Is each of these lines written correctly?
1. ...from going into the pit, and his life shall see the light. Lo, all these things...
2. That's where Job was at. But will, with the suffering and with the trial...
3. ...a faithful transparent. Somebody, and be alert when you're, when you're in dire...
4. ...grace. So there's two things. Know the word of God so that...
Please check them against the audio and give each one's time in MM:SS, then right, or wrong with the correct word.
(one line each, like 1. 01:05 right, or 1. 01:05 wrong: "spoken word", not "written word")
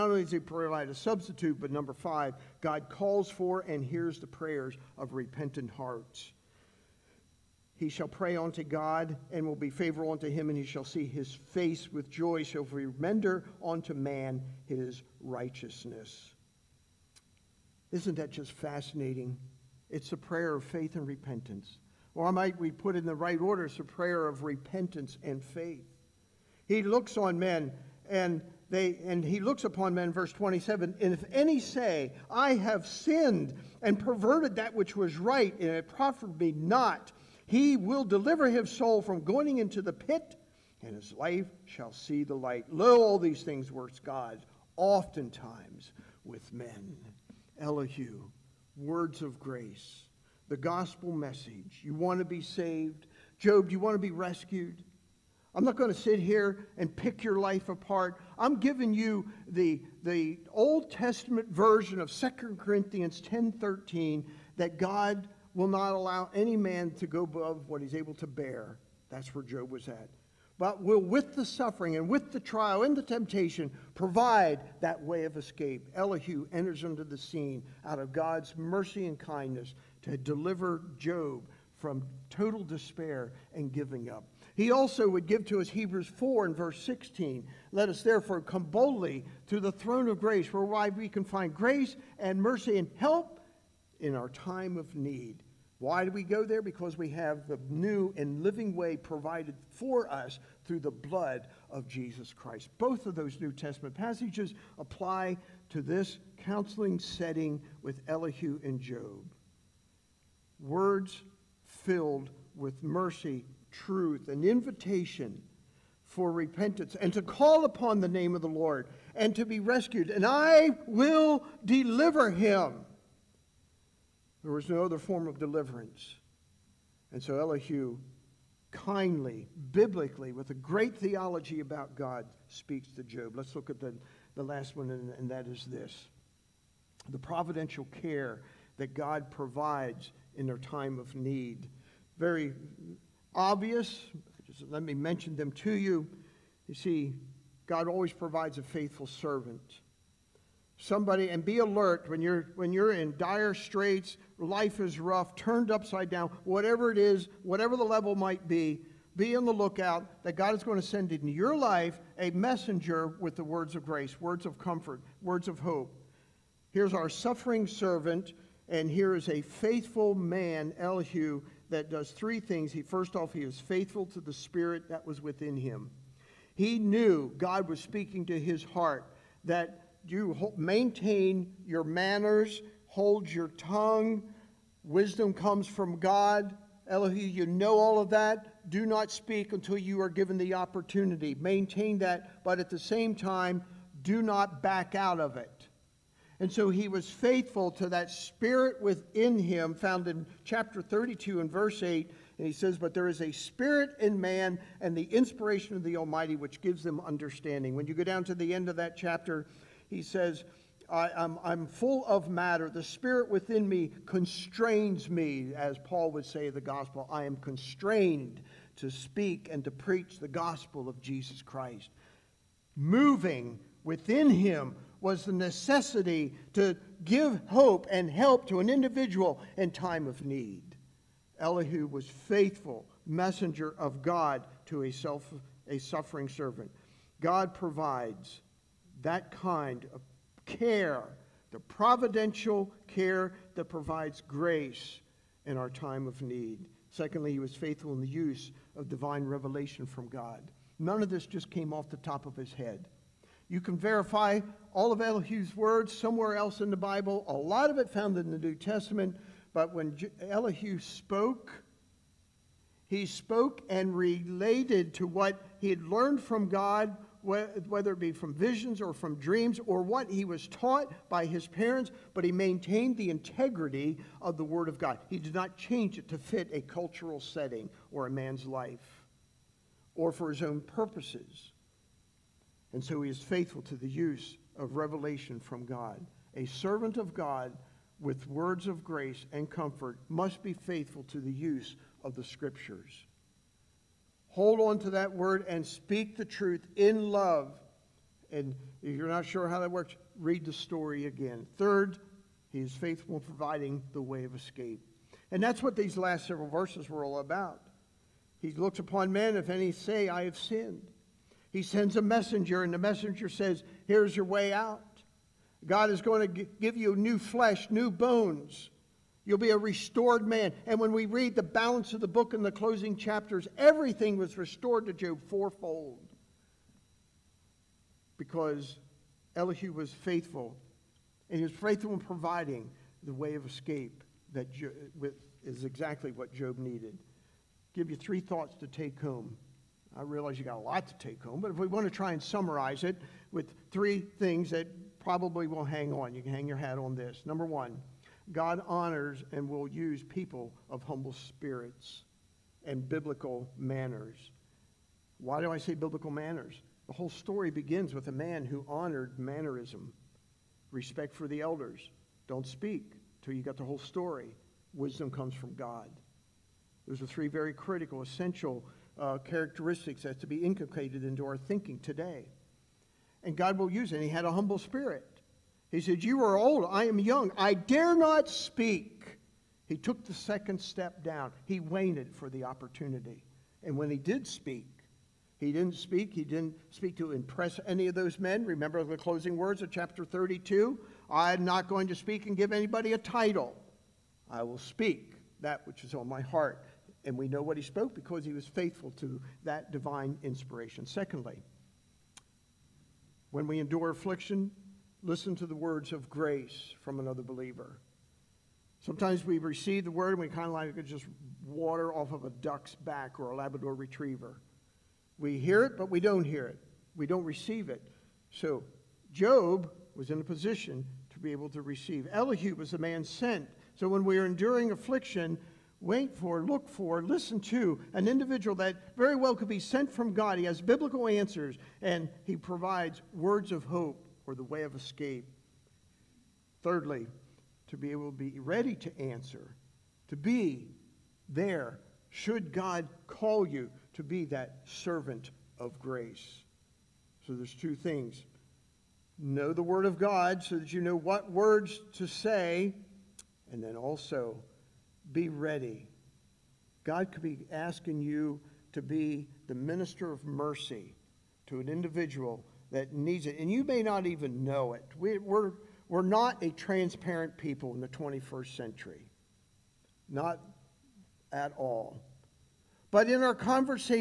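1. 00:39 right
2. 01:09 right
3. 02:28 wrong: "servant", not "transparent"
4. 07:25 right.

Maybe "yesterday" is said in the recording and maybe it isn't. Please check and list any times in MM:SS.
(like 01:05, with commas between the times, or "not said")
not said.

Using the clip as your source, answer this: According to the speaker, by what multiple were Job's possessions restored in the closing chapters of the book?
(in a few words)
Fourfold.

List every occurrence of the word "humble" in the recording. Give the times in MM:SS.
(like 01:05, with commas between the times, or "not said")
05:50, 06:14.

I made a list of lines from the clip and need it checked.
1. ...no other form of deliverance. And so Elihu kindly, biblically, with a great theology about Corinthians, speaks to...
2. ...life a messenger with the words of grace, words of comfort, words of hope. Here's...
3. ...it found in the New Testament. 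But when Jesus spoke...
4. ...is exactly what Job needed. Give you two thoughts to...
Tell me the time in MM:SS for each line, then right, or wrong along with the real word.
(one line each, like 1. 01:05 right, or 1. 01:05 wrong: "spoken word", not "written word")
1. 02:04 wrong: "God", not "Corinthians"
2. 02:41 right
3. 04:17 wrong: "Elihu", not "Jesus"
4. 05:35 wrong: "three", not "two".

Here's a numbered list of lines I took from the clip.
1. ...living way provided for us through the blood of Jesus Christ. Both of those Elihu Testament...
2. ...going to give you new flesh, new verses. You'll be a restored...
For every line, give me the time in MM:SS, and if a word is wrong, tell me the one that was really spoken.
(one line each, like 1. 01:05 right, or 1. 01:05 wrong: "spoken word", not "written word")
1. 01:38 wrong: "New", not "Elihu"
2. 05:16 wrong: "bones", not "verses".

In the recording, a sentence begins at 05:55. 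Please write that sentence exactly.
Why do I say biblical manners?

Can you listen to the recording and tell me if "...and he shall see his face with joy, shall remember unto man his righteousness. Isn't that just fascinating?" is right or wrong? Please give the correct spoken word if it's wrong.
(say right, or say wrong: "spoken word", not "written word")
right.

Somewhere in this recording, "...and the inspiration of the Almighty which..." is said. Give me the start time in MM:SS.
03:24.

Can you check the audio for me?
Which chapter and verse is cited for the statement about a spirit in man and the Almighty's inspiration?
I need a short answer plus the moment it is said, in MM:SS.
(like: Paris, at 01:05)
Chapter 32, verse 8, at 03:20.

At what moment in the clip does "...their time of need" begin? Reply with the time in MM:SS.
02:20.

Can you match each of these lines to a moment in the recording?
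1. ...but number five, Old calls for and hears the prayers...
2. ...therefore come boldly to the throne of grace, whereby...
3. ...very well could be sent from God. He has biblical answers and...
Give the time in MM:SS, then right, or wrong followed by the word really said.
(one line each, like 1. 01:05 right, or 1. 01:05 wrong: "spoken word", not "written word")
1. 00:01 wrong: "God", not "Old"
2. 01:28 right
3. 07:08 right.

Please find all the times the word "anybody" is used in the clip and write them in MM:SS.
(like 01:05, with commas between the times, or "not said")
06:32.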